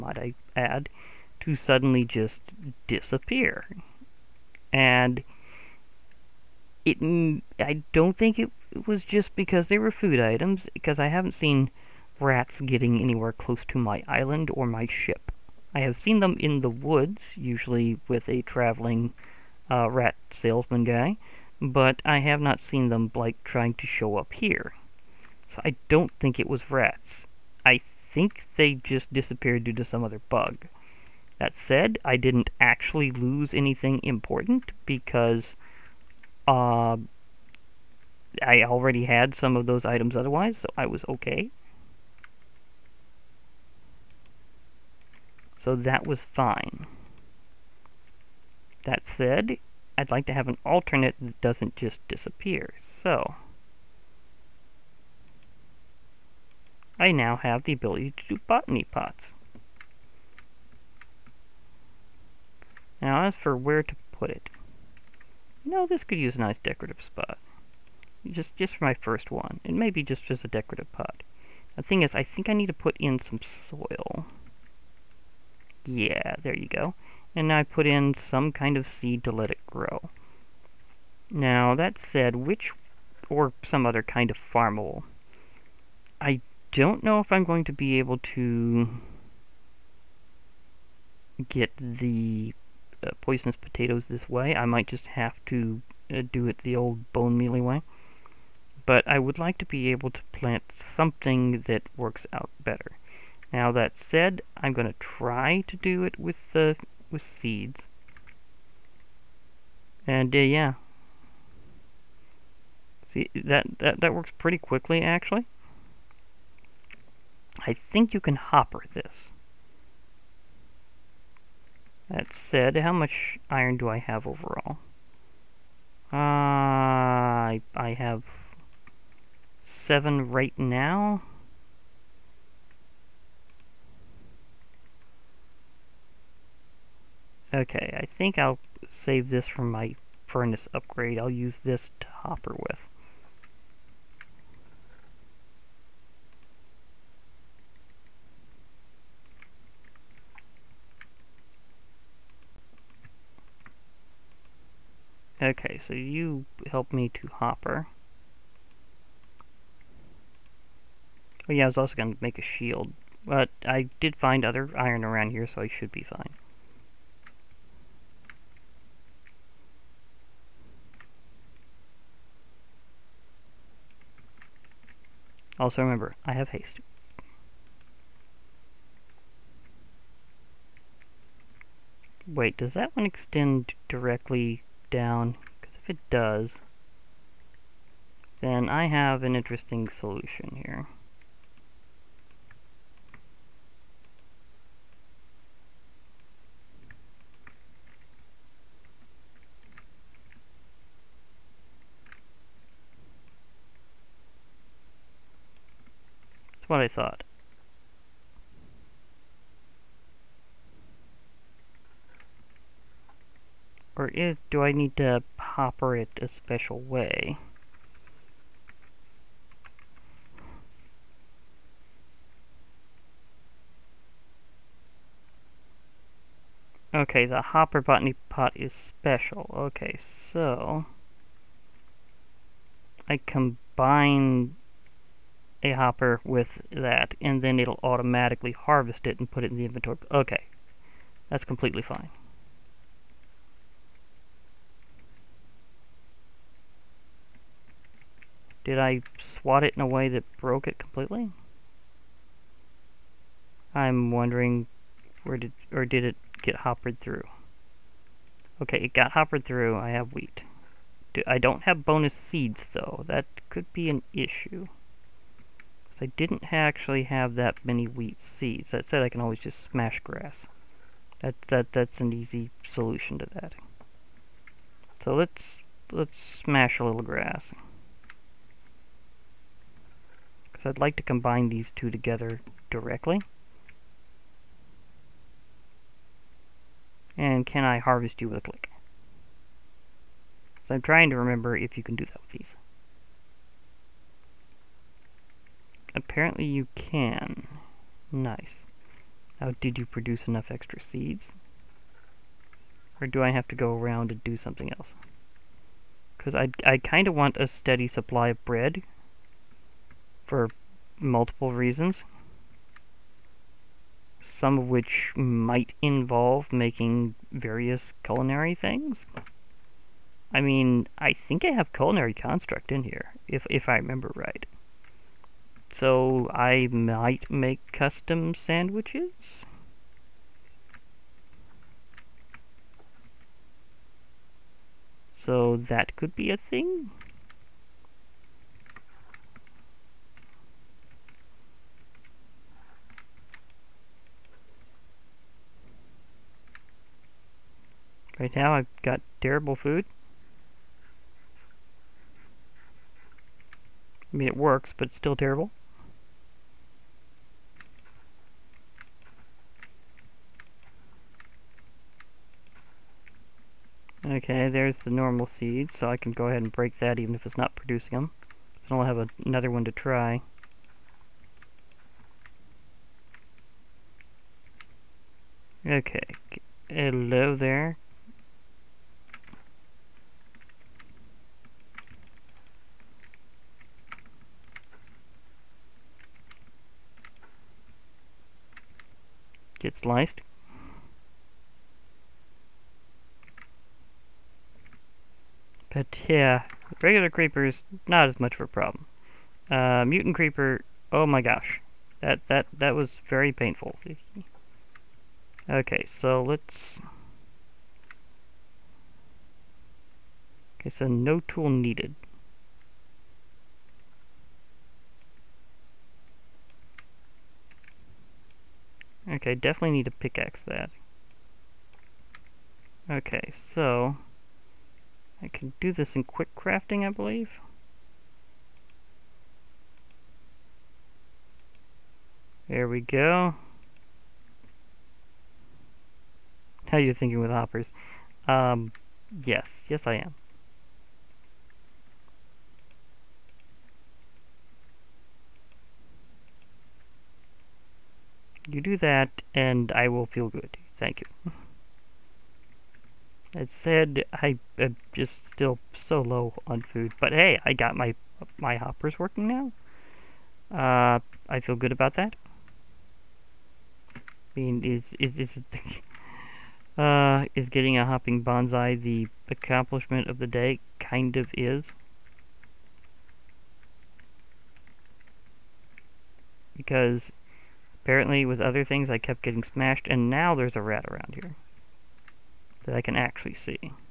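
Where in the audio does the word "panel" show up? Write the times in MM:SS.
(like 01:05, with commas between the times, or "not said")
not said.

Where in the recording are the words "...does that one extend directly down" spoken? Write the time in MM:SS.
03:02.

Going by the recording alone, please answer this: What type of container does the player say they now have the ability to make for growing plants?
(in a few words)
Botany pots.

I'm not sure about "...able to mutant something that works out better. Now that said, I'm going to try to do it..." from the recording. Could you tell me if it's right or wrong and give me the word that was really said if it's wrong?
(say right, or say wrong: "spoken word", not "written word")
wrong: "plant", not "mutant".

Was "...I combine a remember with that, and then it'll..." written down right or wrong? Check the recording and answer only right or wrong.
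wrong.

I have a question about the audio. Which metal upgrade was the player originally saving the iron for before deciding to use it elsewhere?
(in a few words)
Furnace upgrade.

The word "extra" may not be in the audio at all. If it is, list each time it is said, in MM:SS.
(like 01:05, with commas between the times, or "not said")
05:00.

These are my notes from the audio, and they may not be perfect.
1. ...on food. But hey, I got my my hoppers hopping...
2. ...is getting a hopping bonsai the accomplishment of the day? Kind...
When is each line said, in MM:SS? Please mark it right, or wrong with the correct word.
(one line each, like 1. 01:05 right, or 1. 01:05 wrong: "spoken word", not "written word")
1. 07:36 wrong: "working", not "hopping"
2. 07:47 right.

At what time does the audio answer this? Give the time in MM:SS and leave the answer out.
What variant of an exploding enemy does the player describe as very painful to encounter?
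06:39.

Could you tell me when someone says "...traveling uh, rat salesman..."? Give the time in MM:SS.
00:18.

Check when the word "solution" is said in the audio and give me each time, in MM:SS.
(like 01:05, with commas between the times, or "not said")
03:09, 04:32.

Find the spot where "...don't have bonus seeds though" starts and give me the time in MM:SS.
04:21.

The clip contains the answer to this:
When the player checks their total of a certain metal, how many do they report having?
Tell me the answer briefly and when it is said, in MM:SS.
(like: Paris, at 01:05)
7, at 02:09.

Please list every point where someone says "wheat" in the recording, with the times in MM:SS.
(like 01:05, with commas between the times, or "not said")
04:20, 04:27.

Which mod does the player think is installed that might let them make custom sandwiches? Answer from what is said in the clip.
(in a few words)
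Culinary Construct.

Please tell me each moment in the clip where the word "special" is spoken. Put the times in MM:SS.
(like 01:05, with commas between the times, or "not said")
03:36, 03:48.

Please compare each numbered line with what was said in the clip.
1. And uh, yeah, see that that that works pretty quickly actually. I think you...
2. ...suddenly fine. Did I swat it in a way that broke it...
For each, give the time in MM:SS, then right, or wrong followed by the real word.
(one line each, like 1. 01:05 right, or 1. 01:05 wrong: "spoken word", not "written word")
1. 01:50 right
2. 04:01 wrong: "completely", not "suddenly".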